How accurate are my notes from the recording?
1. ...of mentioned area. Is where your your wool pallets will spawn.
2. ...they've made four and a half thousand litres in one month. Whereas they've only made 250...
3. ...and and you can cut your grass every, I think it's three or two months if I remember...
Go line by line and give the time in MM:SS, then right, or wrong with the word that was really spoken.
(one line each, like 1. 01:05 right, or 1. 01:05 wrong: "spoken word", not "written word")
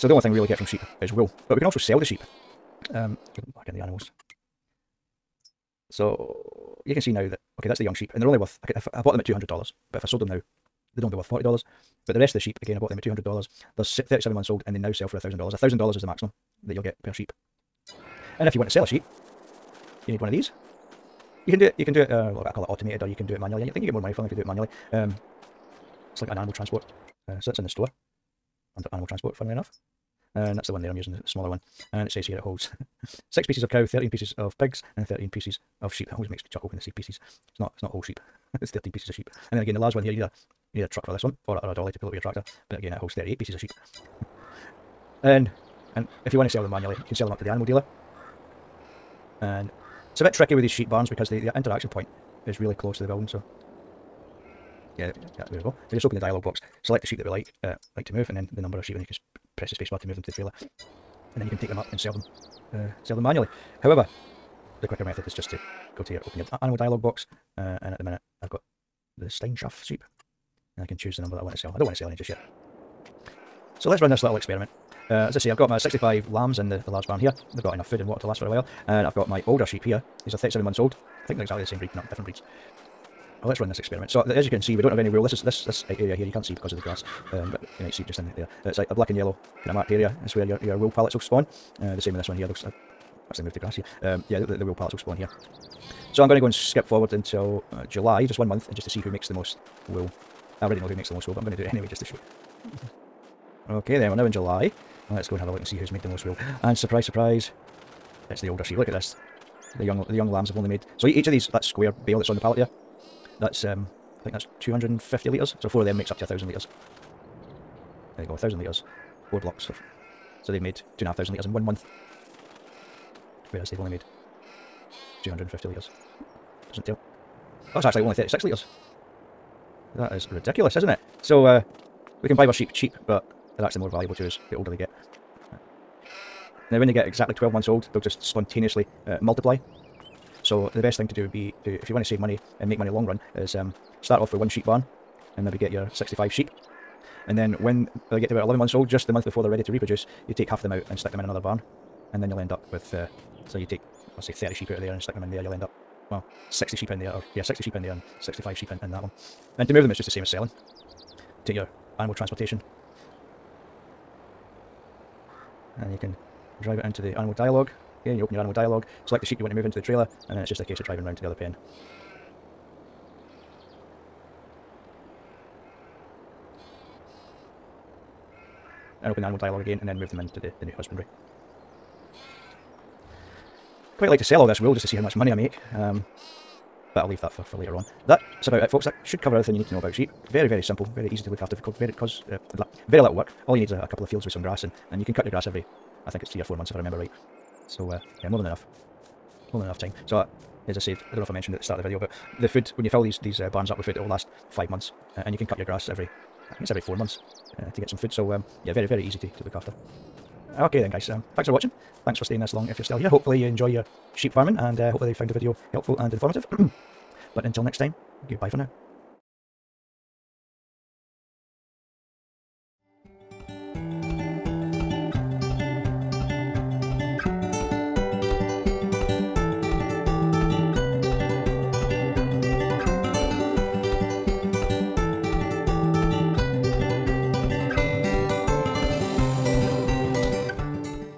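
1. 01:29 wrong: "marked", not "mentioned"
2. 02:00 wrong: "two", not "four"
3. 03:14 wrong: "four", not "two".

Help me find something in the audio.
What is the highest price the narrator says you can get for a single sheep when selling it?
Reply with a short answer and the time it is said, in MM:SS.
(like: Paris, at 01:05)
$1,000, at 00:15.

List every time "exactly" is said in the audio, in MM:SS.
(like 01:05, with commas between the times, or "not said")
01:21, 02:17.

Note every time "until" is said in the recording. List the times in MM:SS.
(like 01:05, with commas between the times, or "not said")
01:37, 03:37.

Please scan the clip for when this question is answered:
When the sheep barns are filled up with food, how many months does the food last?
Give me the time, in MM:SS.
03:24.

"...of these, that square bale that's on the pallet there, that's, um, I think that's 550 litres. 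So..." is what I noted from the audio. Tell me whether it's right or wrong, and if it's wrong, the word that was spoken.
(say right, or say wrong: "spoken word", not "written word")
wrong: "250", not "550".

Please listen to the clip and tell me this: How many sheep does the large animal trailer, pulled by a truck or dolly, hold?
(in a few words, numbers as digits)
38.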